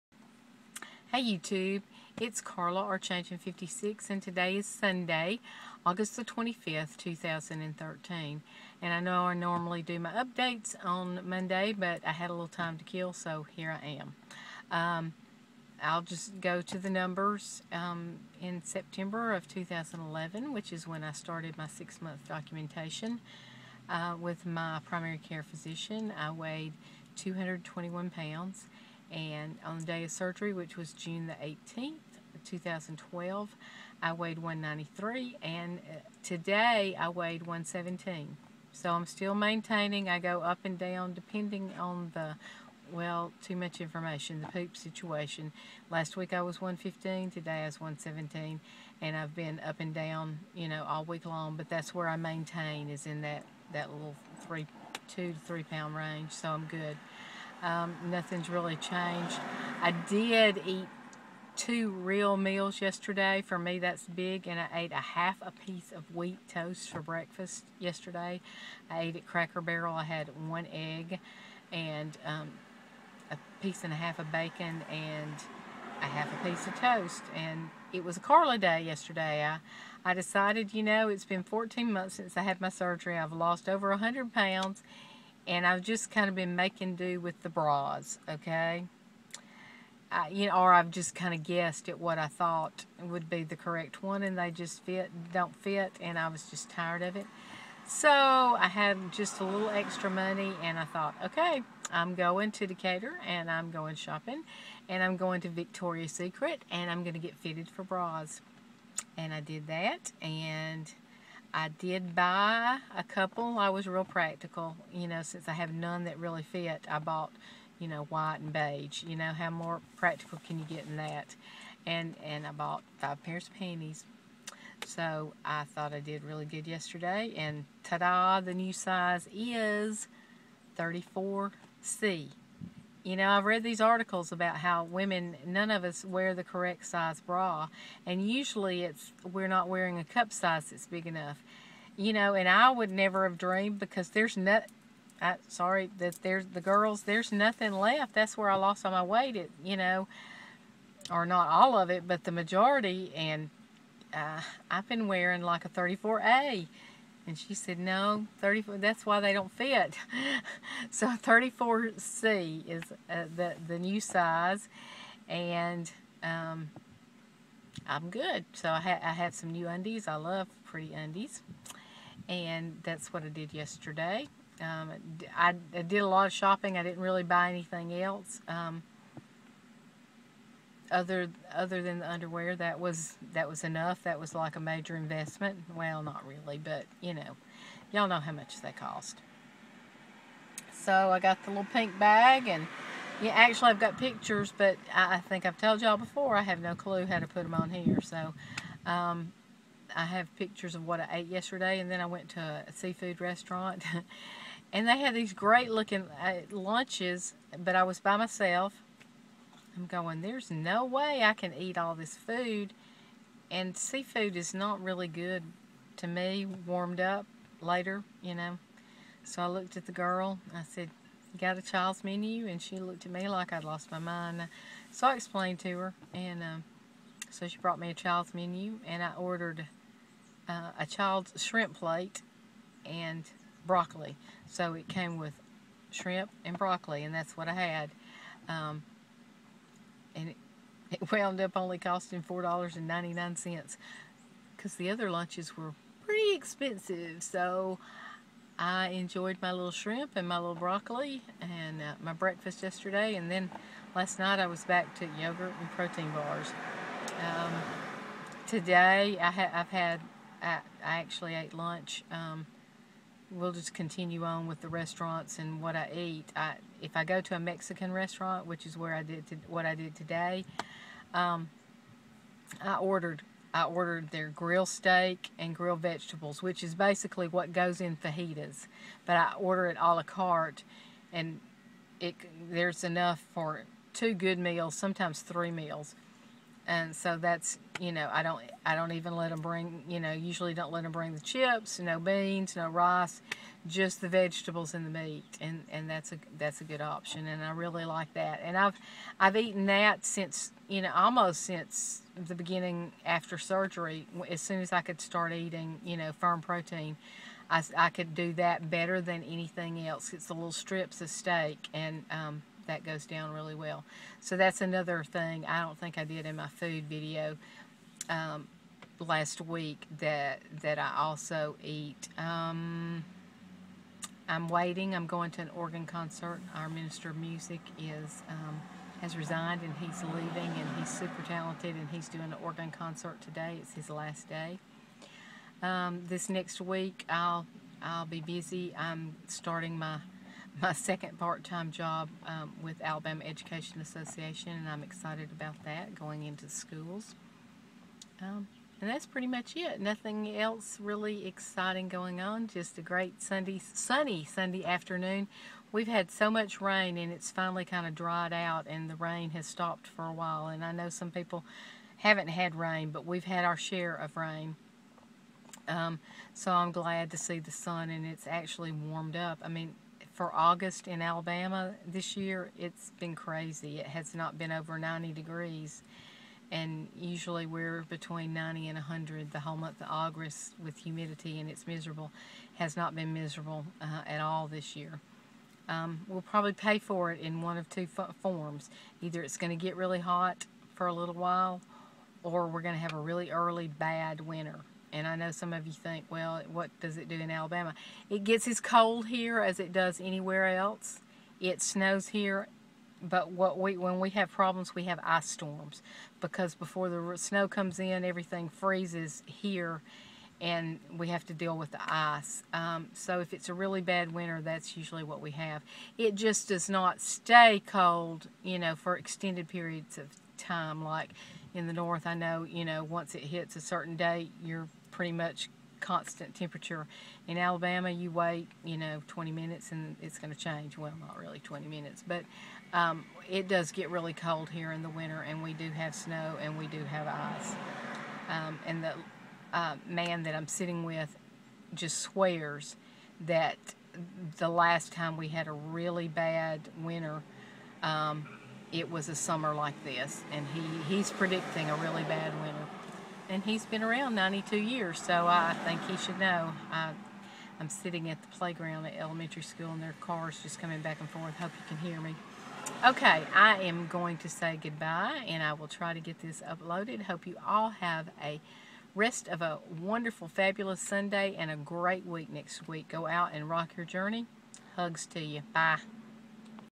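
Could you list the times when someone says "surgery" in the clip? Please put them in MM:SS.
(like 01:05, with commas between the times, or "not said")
00:30, 01:22, 05:03.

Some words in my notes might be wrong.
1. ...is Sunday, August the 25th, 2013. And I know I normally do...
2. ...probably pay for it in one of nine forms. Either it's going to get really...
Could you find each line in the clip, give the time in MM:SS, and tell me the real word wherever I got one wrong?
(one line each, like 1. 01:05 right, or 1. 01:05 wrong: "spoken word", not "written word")
1. 00:04 right
2. 06:26 wrong: "two", not "nine".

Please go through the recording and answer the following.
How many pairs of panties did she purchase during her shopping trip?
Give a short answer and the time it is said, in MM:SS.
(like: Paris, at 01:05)
5, at 02:02.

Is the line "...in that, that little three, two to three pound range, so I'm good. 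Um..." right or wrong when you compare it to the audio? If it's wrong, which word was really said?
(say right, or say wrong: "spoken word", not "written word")
right.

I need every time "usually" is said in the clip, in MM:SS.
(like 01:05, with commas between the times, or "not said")
02:18, 04:50, 06:16, 06:54.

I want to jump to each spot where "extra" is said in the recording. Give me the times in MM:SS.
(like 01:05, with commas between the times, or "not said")
01:39.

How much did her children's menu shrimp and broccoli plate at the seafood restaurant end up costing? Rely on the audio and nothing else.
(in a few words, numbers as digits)
$4.99.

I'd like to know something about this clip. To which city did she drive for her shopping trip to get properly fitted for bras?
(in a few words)
Decatur.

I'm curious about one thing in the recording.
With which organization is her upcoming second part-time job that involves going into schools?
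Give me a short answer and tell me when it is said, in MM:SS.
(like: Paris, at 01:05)
Alabama Education Association, at 05:42.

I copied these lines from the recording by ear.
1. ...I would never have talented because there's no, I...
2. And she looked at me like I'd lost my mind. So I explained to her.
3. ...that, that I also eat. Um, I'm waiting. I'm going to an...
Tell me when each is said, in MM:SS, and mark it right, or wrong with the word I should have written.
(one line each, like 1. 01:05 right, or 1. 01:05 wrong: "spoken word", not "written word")
1. 02:22 wrong: "dreamed", not "talented"
2. 03:42 right
3. 05:19 right.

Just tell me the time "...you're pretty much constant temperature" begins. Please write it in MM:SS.
07:04.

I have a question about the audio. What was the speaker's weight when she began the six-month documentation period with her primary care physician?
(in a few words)
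221 pounds.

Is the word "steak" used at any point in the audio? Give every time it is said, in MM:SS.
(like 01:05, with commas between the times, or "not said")
04:34, 05:11.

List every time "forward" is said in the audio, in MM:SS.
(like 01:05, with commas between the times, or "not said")
not said.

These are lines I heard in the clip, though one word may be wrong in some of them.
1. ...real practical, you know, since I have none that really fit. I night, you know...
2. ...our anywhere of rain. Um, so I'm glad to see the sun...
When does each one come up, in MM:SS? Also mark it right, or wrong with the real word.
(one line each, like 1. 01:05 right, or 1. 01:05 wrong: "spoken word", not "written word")
1. 01:53 wrong: "bought", not "night"
2. 06:03 wrong: "share", not "anywhere".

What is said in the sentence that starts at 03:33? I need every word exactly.
And seafood is not really good to me, warmed up later, you know.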